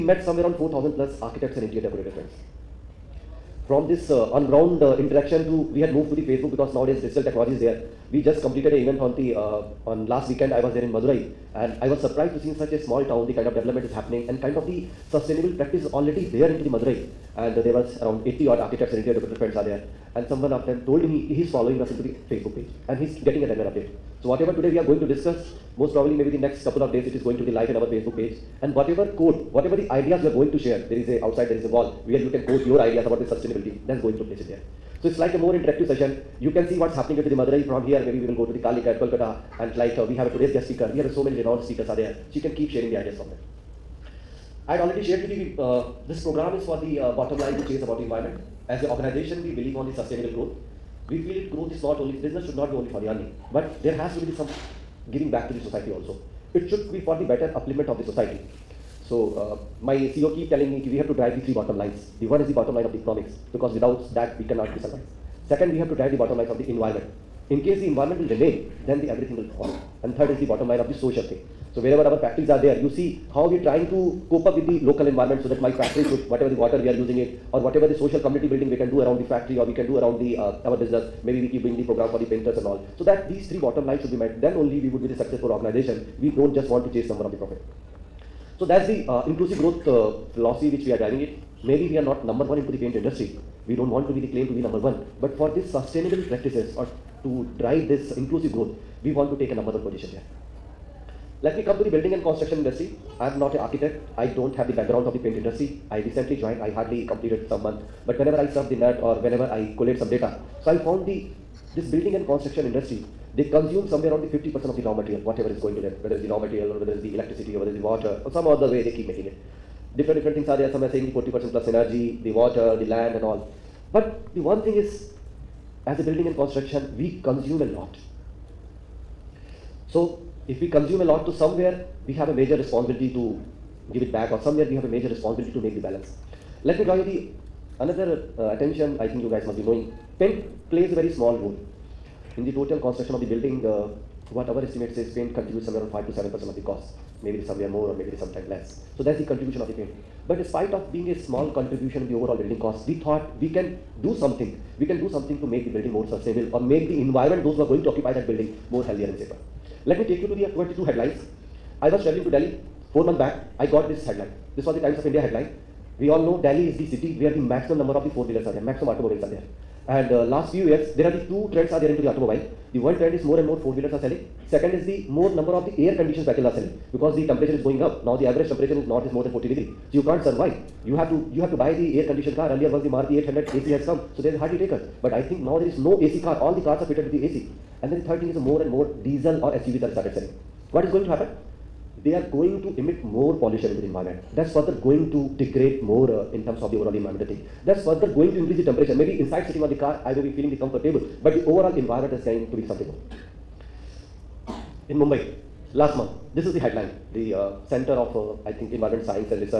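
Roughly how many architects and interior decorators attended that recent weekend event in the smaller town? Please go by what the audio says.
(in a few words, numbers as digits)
80.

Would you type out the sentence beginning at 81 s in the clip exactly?
Maybe we keep doing the program for the painters and all.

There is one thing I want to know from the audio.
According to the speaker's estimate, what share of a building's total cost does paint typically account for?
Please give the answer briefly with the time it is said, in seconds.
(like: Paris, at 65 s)
5 to 7 percent, at 145 s.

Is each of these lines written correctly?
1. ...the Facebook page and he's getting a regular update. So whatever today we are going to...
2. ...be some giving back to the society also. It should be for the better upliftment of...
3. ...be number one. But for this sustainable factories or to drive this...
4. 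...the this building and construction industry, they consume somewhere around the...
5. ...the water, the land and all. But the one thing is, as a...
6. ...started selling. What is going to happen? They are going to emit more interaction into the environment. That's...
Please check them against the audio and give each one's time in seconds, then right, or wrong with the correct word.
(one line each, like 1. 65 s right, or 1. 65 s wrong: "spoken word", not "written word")
1. 22 s right
2. 54 s right
3. 94 s wrong: "practices", not "factories"
4. 111 s right
5. 122 s right
6. 189 s wrong: "pollution", not "interaction".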